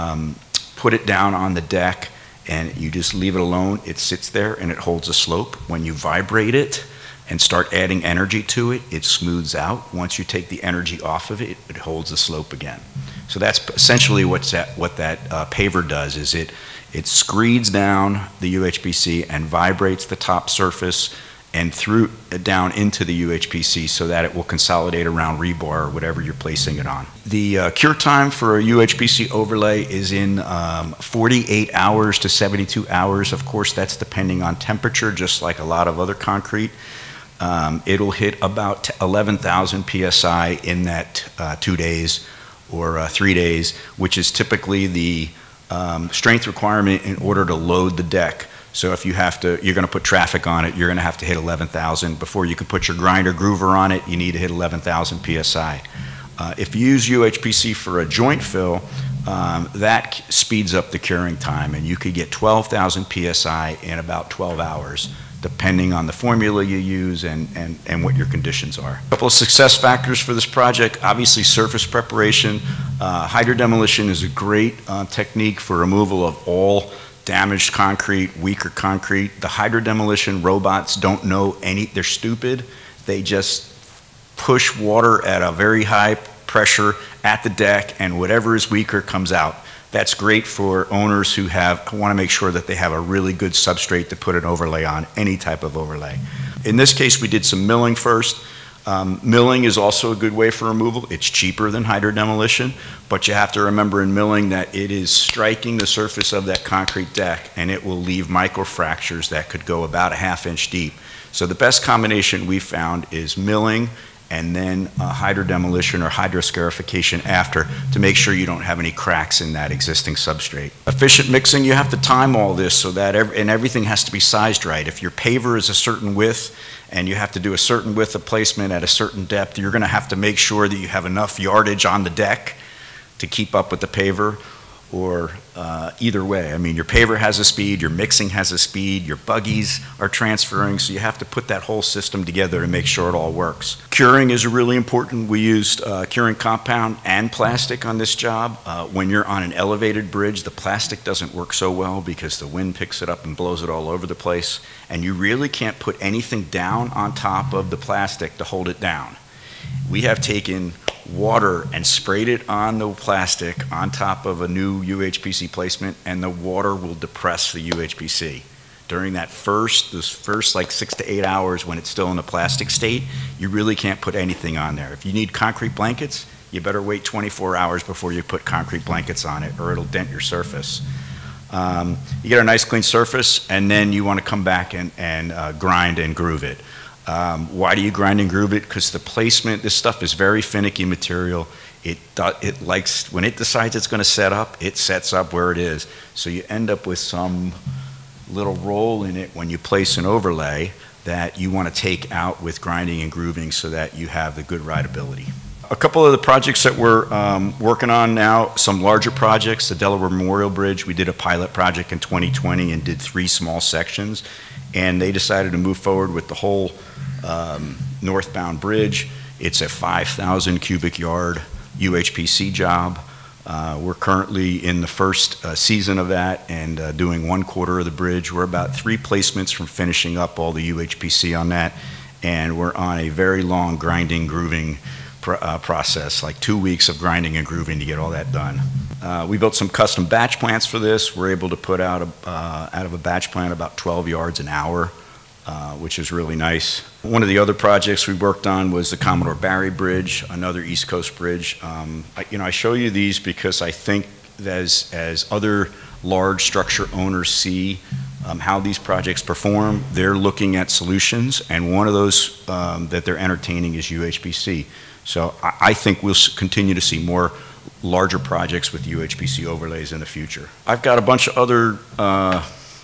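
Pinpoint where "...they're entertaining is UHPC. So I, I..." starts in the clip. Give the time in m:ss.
4:23.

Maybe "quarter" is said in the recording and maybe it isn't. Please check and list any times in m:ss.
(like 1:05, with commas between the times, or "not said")
3:47.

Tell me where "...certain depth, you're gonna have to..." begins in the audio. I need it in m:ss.
2:08.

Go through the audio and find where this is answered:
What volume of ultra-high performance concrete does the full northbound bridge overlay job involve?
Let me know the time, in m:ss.
3:39.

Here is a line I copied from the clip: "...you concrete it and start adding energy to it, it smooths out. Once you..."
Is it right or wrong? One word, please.
wrong.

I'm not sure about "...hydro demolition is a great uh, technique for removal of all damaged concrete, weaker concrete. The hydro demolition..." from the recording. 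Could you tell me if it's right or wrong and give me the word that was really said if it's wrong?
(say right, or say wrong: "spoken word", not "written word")
right.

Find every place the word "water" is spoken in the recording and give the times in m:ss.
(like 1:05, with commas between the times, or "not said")
1:24, 2:41, 2:46.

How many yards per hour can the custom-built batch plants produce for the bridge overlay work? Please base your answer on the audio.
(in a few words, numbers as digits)
12 yards.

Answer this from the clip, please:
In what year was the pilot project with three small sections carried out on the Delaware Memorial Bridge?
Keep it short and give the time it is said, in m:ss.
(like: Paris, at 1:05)
2020, at 3:32.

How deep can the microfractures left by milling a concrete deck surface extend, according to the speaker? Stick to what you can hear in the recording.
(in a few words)
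half inch.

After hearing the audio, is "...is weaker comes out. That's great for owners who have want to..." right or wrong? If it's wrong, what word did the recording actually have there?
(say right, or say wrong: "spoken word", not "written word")
right.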